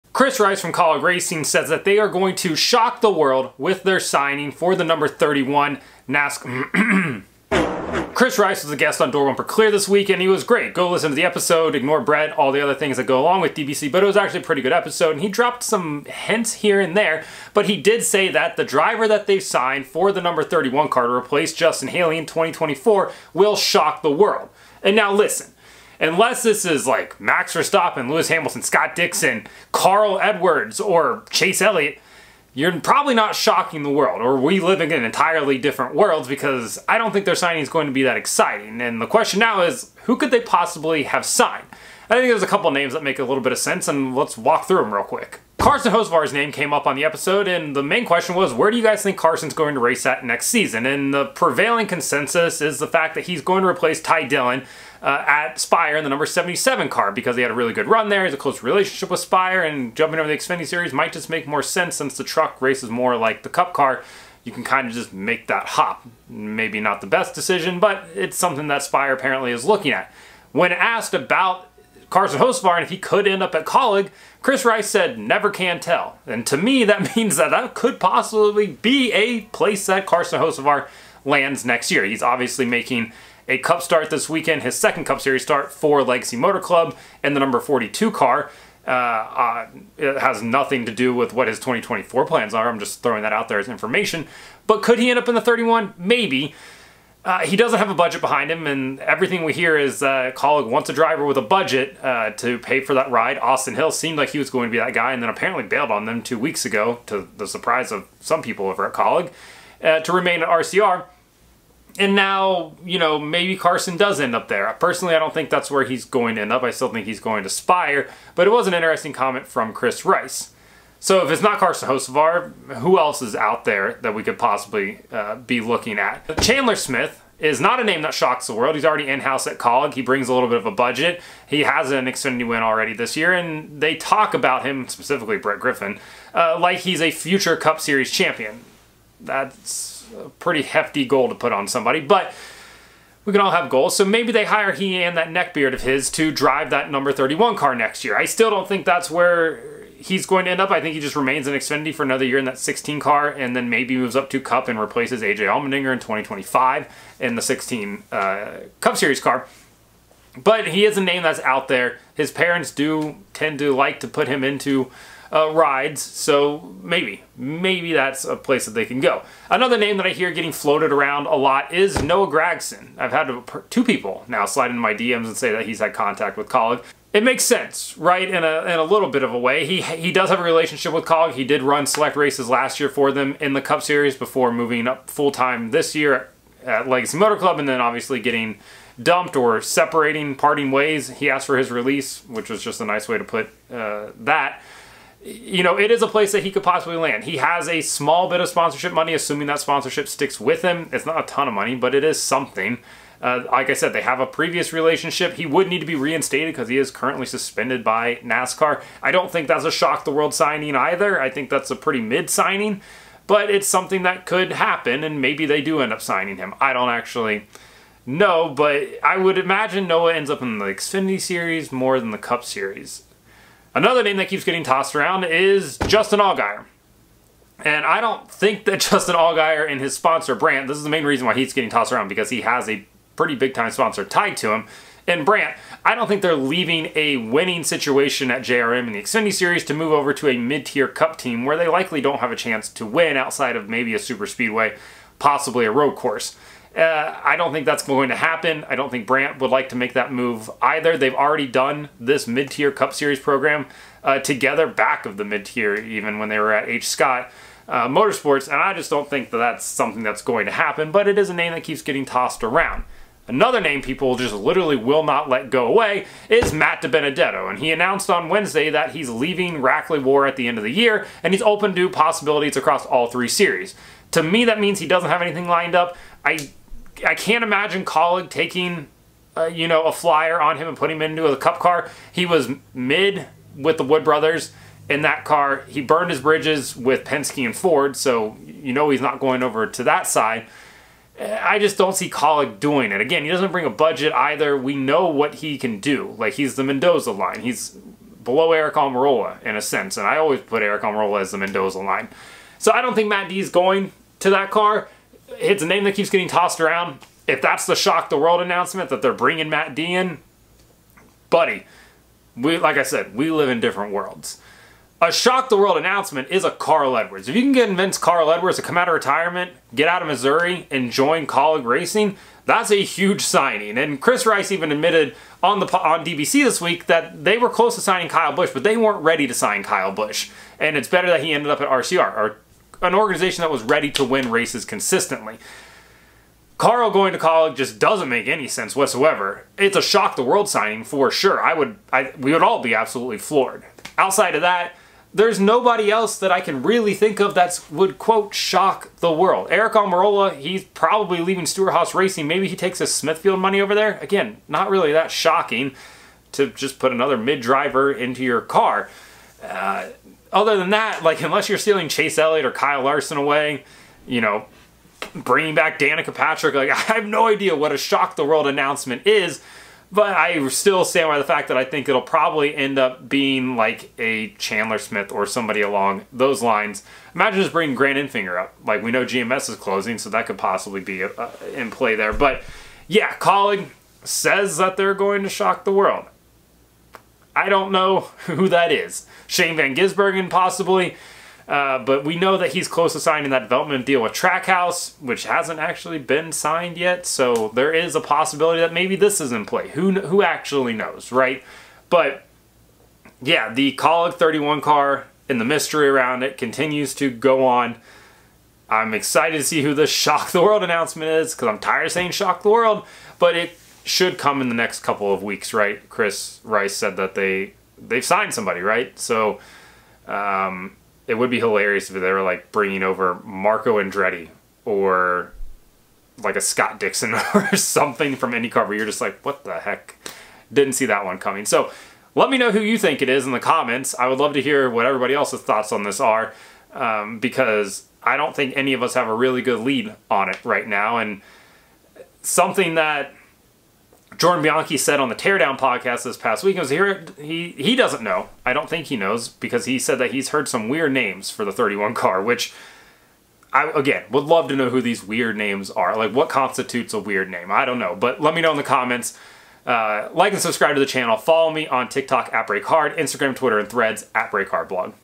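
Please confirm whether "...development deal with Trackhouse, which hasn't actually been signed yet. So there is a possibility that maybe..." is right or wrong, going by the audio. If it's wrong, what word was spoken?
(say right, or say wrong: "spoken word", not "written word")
right.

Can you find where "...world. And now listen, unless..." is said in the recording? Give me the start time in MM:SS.
00:24.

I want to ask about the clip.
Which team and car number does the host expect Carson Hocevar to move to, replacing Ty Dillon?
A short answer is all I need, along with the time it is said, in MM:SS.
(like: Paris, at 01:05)
Spire, number 77, at 00:56.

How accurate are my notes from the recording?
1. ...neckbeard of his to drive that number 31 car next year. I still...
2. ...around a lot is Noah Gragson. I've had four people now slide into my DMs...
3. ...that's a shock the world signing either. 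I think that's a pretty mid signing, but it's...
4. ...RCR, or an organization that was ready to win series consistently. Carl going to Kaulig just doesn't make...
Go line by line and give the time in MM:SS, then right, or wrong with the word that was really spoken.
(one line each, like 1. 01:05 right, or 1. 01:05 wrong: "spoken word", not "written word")
1. 02:25 right
2. 02:50 wrong: "two", not "four"
3. 03:29 right
4. 05:31 wrong: "races", not "series".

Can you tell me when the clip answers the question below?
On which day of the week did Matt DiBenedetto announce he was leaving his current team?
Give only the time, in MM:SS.
04:28.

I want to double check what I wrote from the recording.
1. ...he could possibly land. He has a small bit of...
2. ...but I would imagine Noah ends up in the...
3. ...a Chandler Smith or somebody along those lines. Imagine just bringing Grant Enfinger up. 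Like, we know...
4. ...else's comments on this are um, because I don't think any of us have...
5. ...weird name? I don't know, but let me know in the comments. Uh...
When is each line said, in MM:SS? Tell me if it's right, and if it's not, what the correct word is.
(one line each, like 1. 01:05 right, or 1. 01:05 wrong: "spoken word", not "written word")
1. 03:16 right
2. 03:38 right
3. 06:13 right
4. 07:15 wrong: "thoughts", not "comments"
5. 07:36 right.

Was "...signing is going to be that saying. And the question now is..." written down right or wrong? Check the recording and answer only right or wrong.
wrong.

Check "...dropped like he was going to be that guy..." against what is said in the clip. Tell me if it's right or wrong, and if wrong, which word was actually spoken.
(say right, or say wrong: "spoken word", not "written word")
wrong: "seemed", not "dropped".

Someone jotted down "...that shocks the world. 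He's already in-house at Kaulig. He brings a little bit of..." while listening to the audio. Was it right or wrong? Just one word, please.
right.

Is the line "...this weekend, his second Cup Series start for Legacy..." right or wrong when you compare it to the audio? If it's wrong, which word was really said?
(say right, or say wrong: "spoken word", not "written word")
right.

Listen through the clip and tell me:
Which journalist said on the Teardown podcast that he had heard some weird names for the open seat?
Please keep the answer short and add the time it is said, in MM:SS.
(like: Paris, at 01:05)
Jordan Bianchi, at 07:24.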